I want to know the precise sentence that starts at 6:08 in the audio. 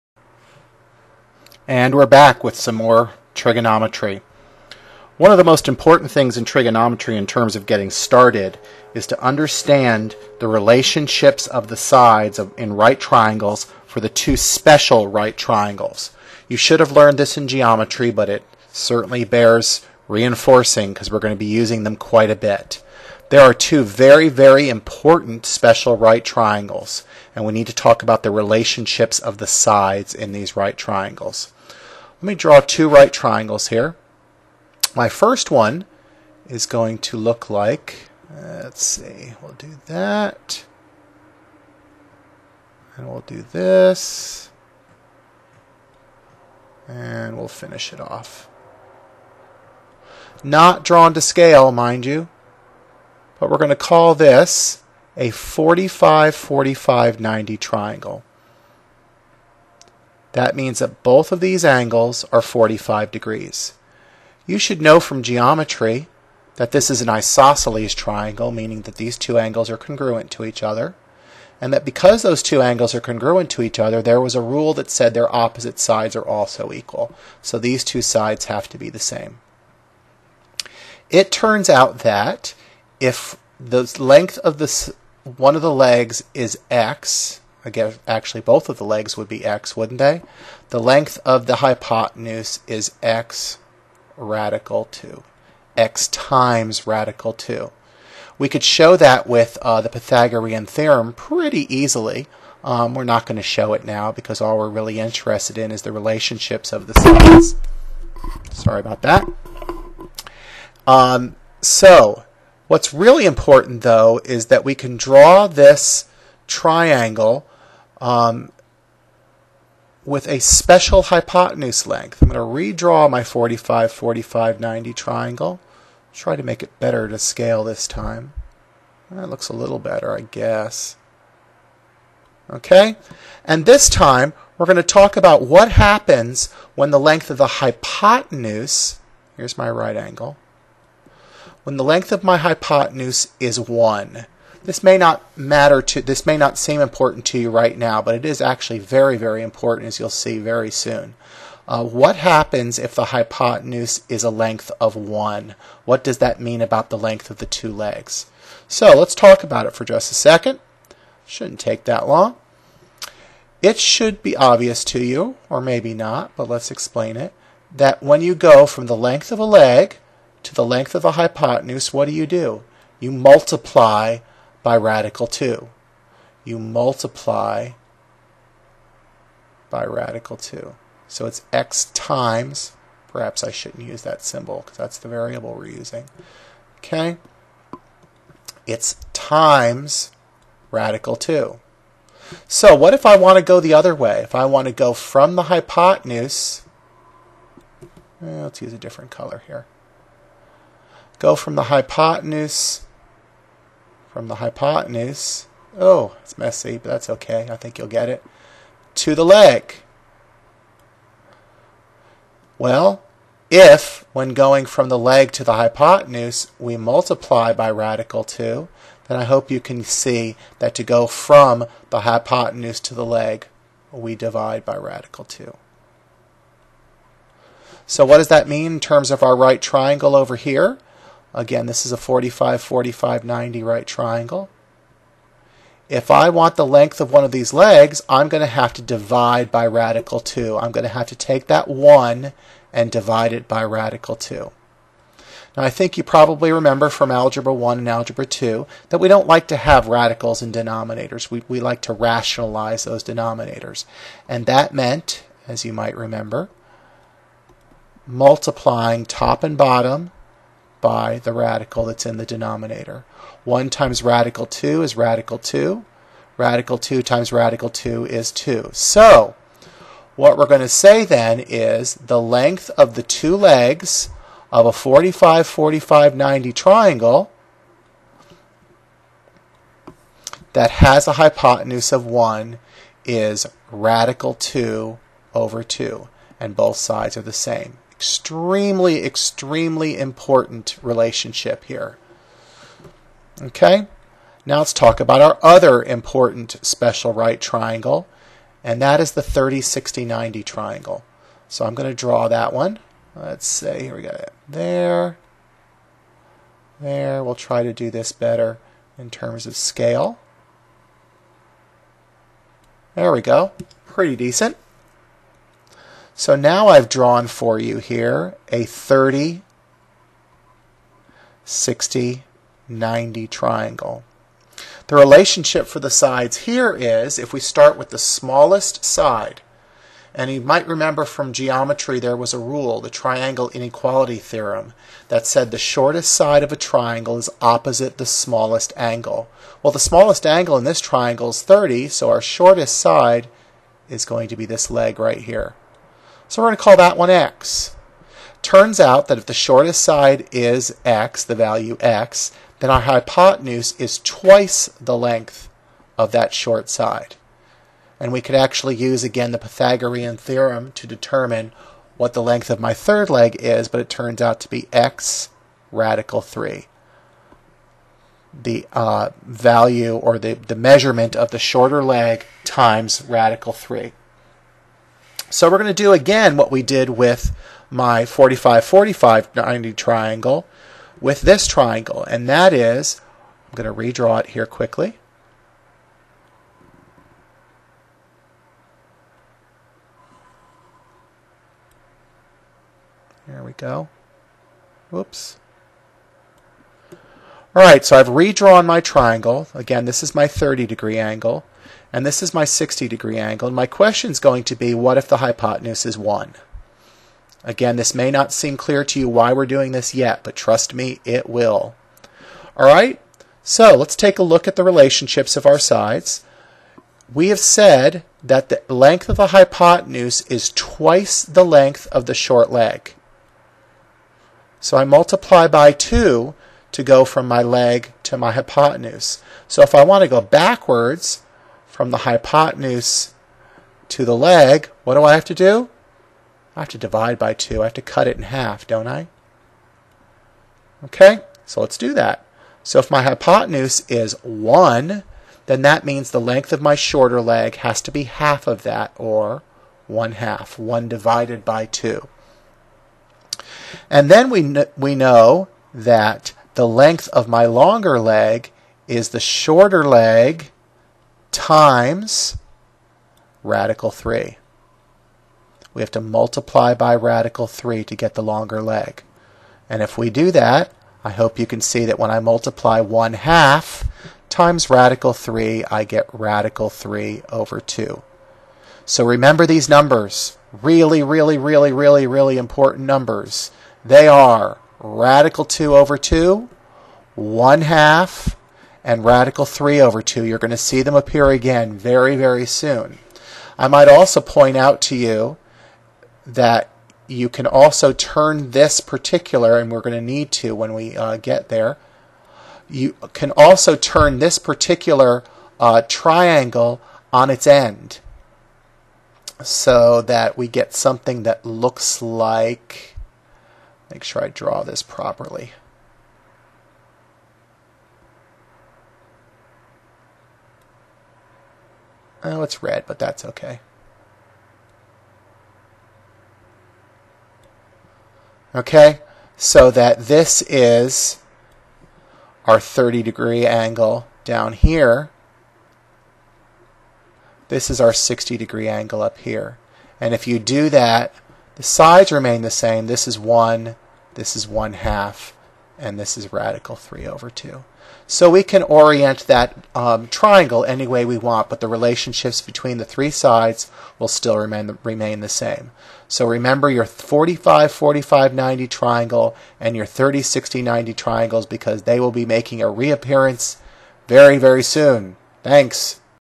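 The uh, value or the, the measurement of the shorter leg times radical 3.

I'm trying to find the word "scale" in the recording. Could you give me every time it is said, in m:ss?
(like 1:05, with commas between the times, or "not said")
0:51, 2:07, 5:09.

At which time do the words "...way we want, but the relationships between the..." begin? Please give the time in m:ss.
9:10.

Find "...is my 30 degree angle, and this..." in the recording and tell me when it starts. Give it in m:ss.
6:40.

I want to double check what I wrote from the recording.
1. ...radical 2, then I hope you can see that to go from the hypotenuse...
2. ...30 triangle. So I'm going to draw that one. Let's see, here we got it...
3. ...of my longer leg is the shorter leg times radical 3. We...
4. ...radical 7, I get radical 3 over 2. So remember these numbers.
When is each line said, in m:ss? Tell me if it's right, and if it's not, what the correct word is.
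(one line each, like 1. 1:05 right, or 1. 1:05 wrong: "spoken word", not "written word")
1. 3:37 right
2. 5:00 wrong: "90", not "30"
3. 7:37 right
4. 7:54 wrong: "3", not "7".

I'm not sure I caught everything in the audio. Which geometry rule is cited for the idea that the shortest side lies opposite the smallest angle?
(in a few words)
triangle inequality theorem.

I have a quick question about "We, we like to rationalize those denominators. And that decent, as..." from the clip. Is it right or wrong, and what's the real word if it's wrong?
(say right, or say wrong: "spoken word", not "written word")
wrong: "meant", not "decent".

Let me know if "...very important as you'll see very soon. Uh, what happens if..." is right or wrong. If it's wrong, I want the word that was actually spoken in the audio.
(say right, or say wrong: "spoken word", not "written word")
right.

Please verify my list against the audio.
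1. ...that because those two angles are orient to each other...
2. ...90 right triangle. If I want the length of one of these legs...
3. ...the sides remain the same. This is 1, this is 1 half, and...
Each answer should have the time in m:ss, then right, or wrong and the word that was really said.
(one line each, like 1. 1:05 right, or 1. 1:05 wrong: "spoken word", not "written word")
1. 1:11 wrong: "congruent", not "orient"
2. 3:53 right
3. 9:01 right.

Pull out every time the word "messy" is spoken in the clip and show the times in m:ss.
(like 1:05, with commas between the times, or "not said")
3:26.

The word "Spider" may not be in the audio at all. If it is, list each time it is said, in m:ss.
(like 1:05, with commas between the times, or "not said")
not said.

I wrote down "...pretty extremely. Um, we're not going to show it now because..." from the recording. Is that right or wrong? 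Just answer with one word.
wrong.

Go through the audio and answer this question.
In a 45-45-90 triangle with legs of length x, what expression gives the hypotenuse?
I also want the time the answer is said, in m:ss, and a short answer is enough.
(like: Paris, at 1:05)
x radical 2, at 1:33.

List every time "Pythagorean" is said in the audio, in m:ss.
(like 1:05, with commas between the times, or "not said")
1:39, 5:59.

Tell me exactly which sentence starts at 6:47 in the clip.
Again, this may not seem clear to you why we're doing this yet, but trust me, it will.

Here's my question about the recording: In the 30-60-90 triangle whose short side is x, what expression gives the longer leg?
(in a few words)
x radical 3.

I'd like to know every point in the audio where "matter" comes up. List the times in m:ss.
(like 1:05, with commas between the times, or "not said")
2:25.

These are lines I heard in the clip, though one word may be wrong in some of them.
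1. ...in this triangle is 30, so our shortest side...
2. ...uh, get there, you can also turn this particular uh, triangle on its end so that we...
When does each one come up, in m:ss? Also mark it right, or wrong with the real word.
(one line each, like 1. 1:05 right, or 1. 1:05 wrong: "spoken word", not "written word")
1. 5:40 right
2. 8:20 right.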